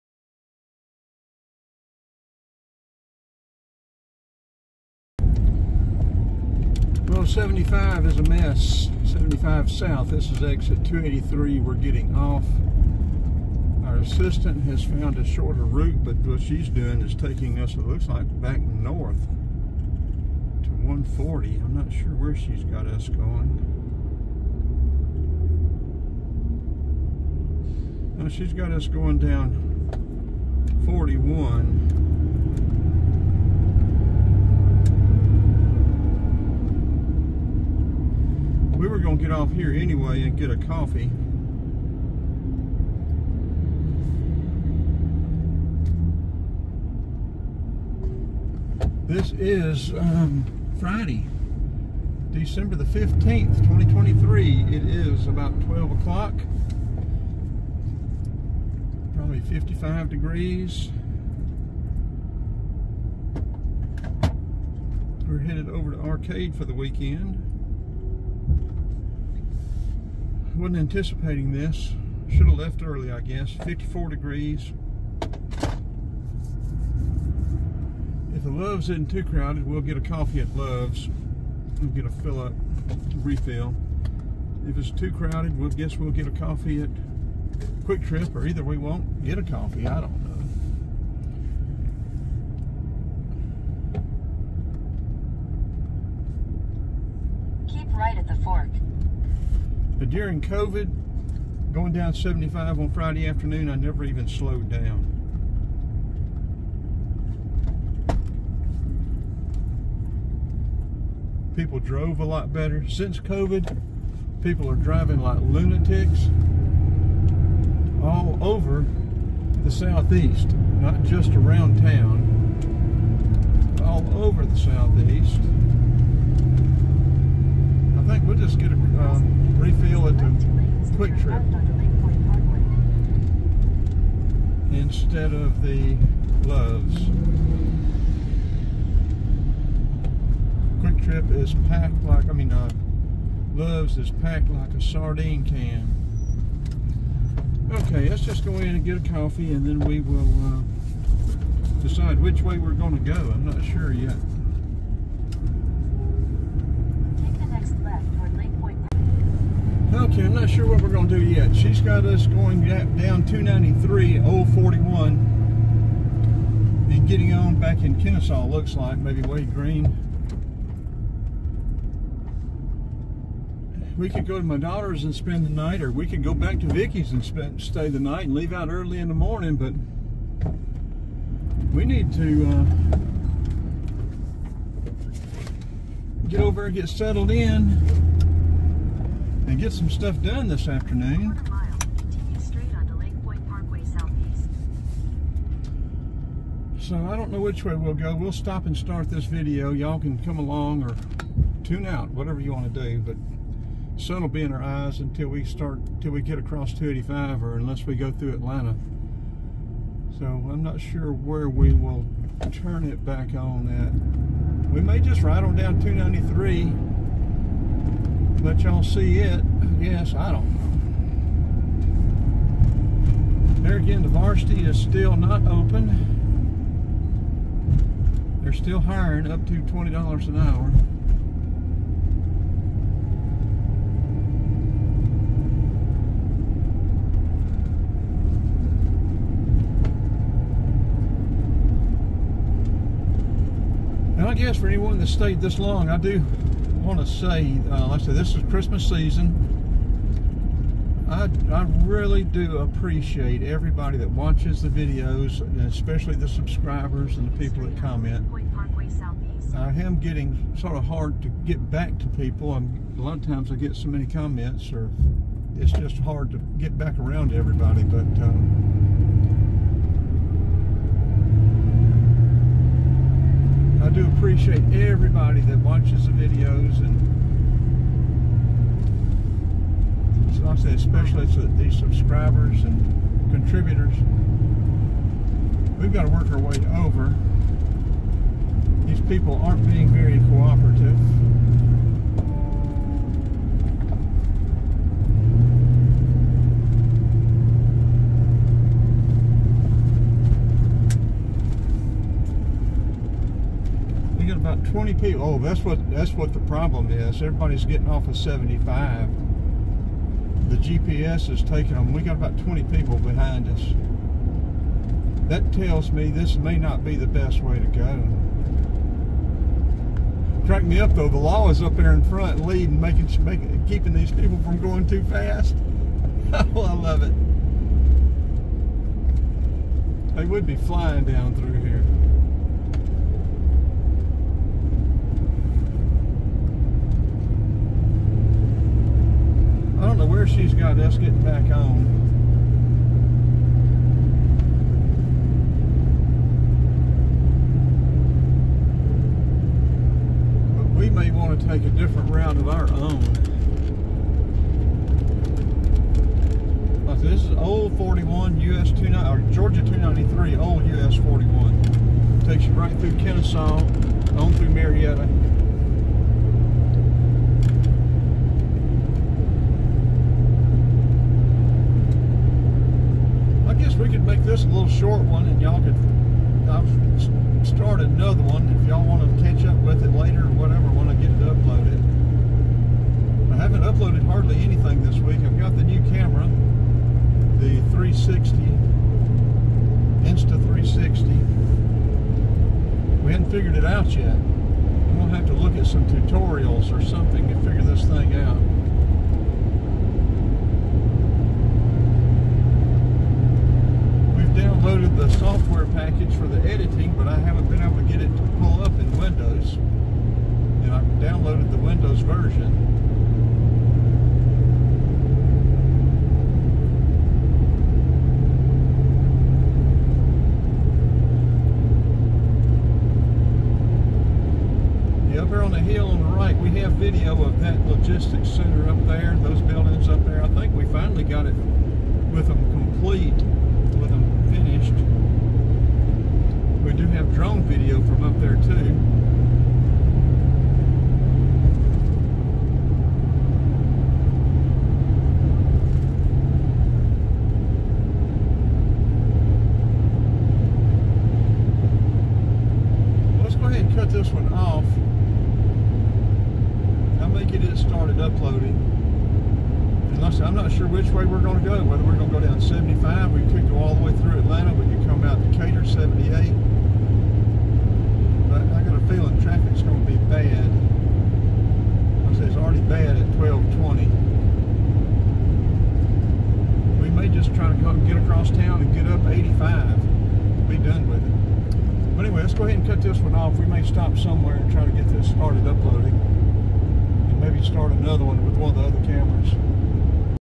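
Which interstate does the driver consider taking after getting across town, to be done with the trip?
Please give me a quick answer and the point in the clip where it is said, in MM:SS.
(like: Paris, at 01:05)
85, at 07:59.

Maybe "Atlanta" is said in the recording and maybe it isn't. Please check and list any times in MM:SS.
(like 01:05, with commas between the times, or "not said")
03:28, 07:44.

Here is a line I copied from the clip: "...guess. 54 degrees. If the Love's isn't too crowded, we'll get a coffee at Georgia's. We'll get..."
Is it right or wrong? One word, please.
wrong.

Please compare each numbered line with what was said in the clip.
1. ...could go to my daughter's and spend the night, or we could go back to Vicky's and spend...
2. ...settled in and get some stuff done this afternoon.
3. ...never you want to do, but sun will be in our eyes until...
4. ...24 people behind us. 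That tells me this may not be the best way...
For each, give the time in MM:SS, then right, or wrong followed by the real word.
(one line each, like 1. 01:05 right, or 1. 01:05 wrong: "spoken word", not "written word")
1. 02:54 right
2. 03:06 right
3. 03:22 wrong: "whatever", not "never"
4. 05:12 wrong: "20", not "24".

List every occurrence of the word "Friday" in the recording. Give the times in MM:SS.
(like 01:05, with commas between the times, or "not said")
00:50, 01:42.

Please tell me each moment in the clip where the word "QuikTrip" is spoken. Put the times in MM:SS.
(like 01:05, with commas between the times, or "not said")
01:27, 02:20.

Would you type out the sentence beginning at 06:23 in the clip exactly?
I haven't uploaded hardly anything this week.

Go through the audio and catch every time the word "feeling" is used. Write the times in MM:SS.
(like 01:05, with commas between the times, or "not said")
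07:48.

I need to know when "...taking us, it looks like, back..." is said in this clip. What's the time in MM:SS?
00:17.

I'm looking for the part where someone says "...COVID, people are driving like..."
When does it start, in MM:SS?
01:53.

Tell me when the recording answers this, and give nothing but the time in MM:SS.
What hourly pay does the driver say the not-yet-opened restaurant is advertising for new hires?
03:49.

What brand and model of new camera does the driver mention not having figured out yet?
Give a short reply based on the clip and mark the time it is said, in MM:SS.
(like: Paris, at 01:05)
Insta360, at 06:30.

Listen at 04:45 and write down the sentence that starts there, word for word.
We've got to work our way over.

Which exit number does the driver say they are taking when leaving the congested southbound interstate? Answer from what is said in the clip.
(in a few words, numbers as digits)
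283.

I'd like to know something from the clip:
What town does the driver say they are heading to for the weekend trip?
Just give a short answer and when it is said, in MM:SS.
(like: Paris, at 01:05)
Arcade, at 01:05.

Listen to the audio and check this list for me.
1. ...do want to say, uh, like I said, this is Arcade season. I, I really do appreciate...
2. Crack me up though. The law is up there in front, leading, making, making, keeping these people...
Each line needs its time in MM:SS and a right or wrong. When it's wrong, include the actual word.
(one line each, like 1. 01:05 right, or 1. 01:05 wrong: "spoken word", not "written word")
1. 04:05 wrong: "Christmas", not "Arcade"
2. 05:20 right.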